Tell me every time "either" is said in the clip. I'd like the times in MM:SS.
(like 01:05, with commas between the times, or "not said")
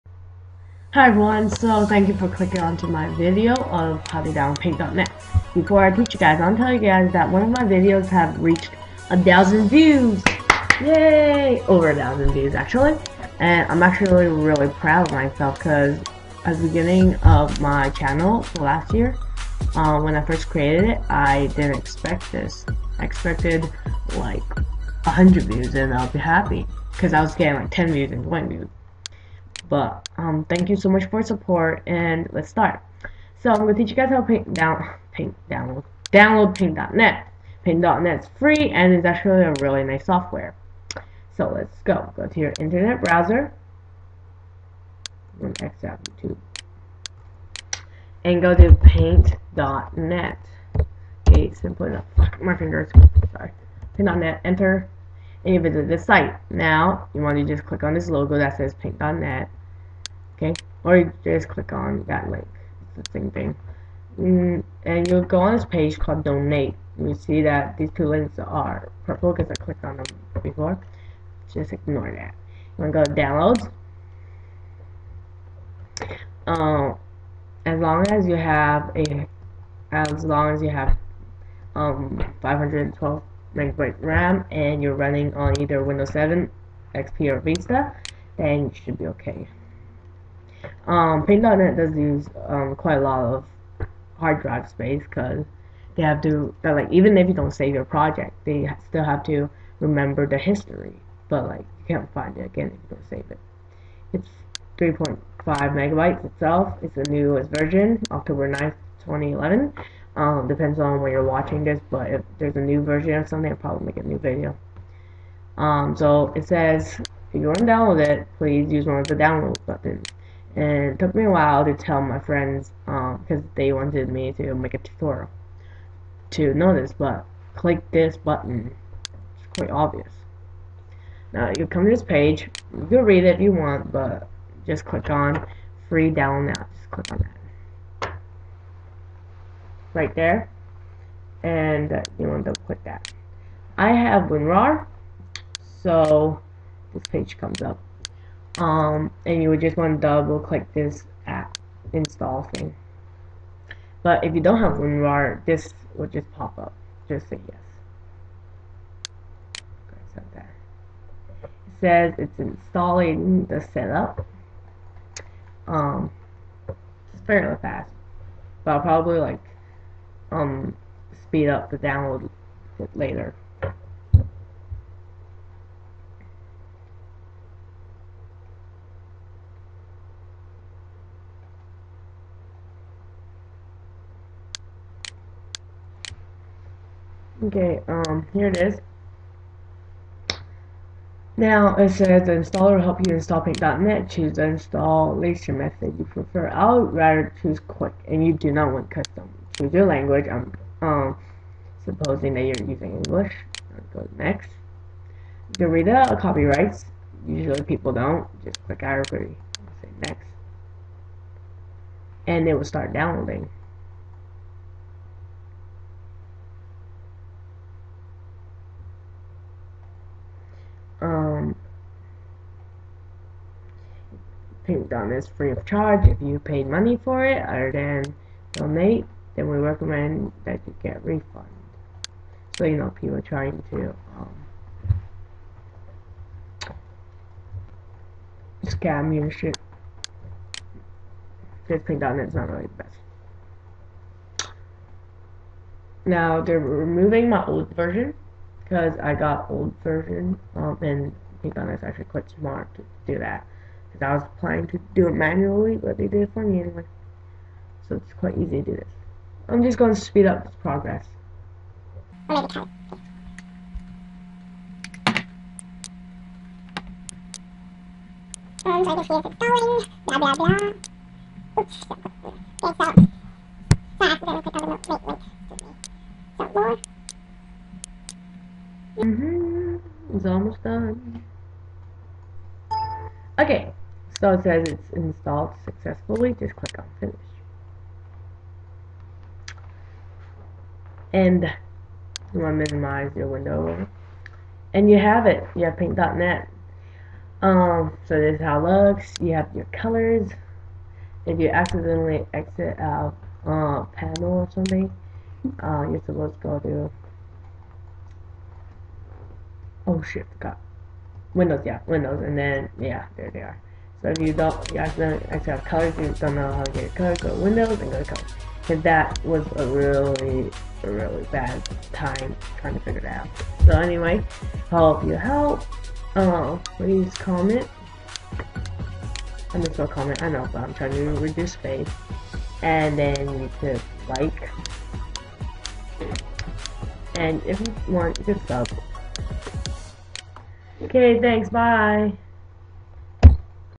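01:25.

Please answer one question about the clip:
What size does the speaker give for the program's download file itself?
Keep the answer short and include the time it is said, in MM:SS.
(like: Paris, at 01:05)
3.5 megabytes, at 01:44.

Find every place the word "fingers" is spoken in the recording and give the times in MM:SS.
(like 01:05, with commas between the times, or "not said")
00:52.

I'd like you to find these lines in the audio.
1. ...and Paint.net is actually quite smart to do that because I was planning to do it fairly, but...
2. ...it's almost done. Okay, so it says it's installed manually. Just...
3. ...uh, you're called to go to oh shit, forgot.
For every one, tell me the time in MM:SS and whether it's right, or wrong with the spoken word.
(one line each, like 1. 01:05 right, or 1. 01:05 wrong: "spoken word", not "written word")
1. 04:10 wrong: "manually", not "fairly"
2. 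04:40 wrong: "successfully", not "manually"
3. 05:05 wrong: "supposed", not "called".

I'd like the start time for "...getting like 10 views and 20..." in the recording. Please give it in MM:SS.
00:27.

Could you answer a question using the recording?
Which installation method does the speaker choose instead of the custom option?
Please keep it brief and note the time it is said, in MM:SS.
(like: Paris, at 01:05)
Quick, at 03:17.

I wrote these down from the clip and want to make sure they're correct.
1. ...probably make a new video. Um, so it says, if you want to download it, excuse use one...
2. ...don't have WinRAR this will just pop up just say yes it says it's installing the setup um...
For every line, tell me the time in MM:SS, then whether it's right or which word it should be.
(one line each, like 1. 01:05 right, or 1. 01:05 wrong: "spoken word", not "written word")
1. 01:53 wrong: "please", not "excuse"
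2. 02:34 right.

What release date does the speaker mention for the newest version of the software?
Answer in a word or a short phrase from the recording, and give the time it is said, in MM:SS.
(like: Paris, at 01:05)
October 9th, 2011, at 01:48.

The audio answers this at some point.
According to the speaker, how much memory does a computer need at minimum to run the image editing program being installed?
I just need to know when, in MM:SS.
01:22.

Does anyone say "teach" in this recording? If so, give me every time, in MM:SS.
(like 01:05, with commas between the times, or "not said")
00:05, 00:33.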